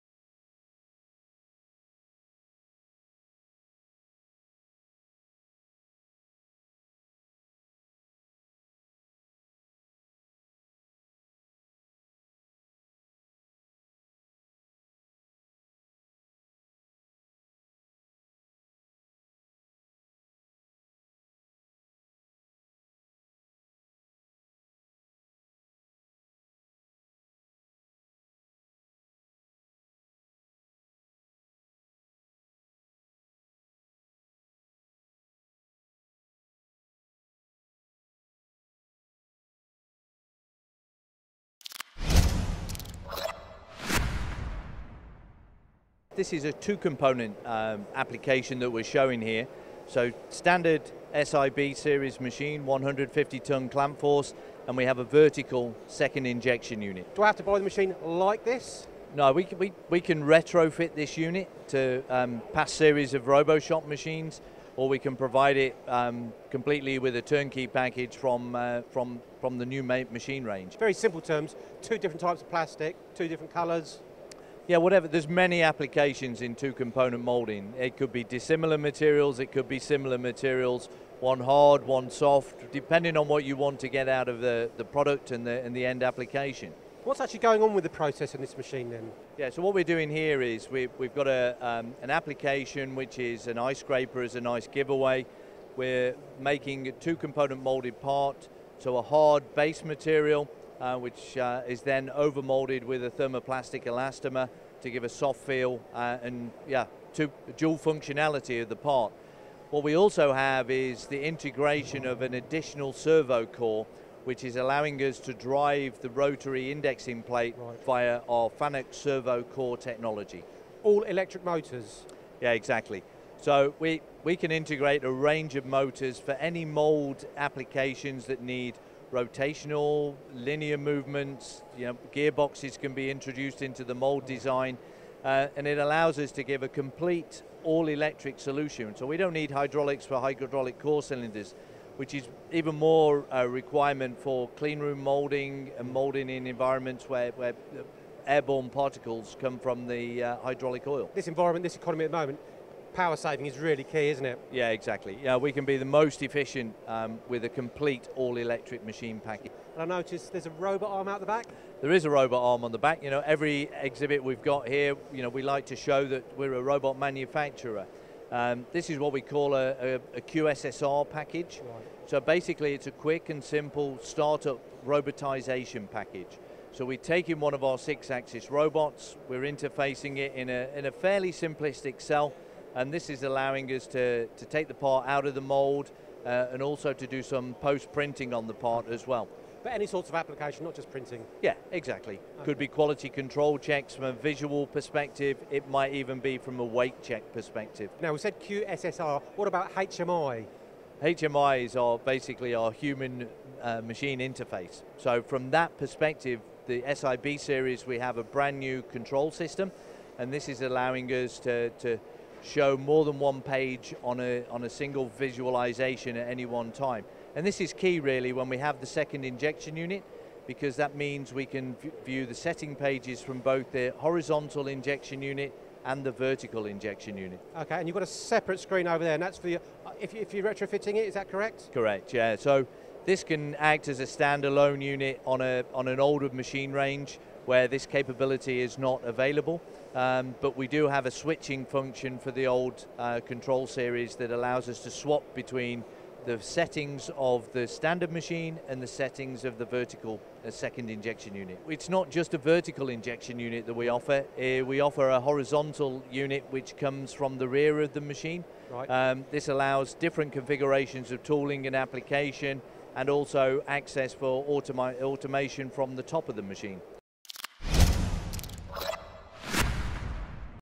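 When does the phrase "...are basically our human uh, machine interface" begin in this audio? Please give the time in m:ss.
3:21.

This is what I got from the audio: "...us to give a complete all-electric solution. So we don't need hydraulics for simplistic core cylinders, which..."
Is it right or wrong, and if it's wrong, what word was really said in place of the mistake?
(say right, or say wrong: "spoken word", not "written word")
wrong: "hydraulic", not "simplistic".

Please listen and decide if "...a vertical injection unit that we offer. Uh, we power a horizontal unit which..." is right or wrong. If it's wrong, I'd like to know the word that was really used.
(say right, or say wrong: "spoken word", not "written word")
wrong: "offer", not "power".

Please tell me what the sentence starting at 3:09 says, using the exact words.
But any sorts of application, not just printing?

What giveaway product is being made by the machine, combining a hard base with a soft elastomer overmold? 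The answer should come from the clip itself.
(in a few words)
An ice scraper.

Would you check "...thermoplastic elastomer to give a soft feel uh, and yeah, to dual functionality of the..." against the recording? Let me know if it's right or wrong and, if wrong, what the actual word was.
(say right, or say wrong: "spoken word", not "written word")
right.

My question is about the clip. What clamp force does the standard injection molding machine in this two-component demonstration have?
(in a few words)
150-ton.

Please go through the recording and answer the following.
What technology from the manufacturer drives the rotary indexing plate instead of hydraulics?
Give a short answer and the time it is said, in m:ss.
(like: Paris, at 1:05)
FANUC servo core technology, at 1:58.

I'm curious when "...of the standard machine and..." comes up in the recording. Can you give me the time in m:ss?
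4:07.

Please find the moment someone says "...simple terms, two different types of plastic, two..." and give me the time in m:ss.
1:10.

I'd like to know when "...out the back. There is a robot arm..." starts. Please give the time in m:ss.
2:41.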